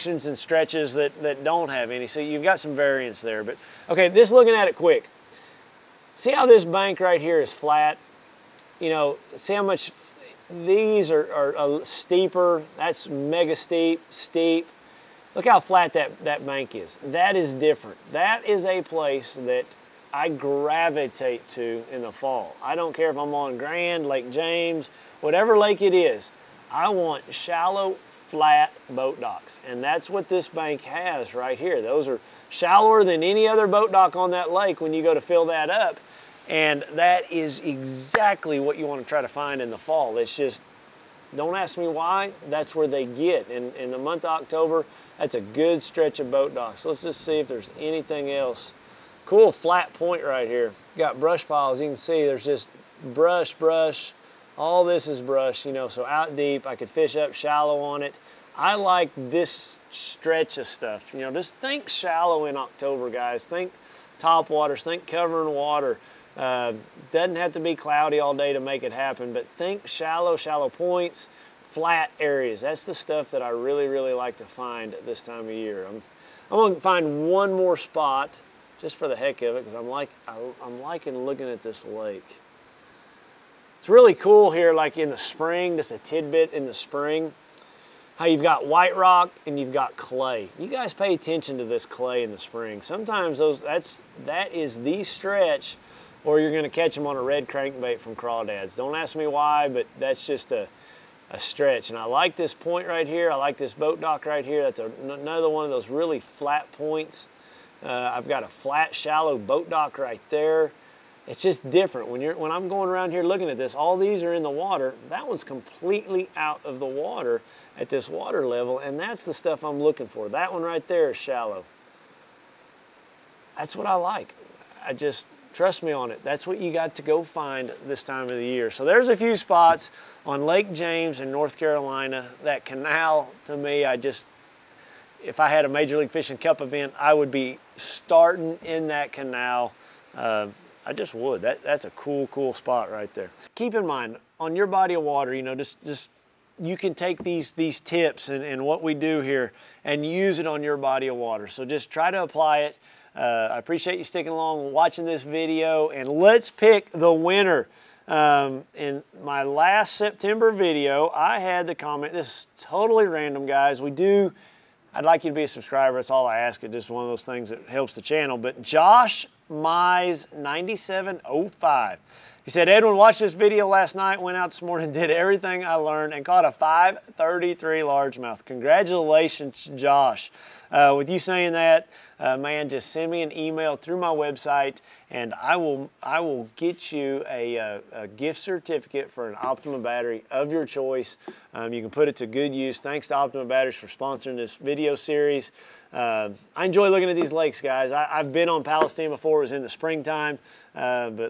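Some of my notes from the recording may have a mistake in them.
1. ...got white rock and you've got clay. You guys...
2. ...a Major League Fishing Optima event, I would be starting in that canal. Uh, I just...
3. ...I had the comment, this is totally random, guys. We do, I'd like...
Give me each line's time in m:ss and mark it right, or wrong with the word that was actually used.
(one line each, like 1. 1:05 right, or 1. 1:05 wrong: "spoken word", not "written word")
1. 1:28 right
2. 2:15 wrong: "Cup", not "Optima"
3. 2:41 right.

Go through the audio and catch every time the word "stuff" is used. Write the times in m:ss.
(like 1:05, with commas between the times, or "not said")
1:00, 1:12, 1:59.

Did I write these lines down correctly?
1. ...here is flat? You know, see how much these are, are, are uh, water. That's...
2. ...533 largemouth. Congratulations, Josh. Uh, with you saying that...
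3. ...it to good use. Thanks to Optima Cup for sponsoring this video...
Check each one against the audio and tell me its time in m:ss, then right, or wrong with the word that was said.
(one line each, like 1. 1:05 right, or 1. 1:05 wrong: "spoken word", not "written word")
1. 0:07 wrong: "steeper", not "water"
2. 2:56 right
3. 3:12 wrong: "Batteries", not "Cup".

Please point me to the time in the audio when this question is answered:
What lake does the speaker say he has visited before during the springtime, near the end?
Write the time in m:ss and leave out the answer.
3:18.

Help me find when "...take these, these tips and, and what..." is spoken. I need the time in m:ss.
2:26.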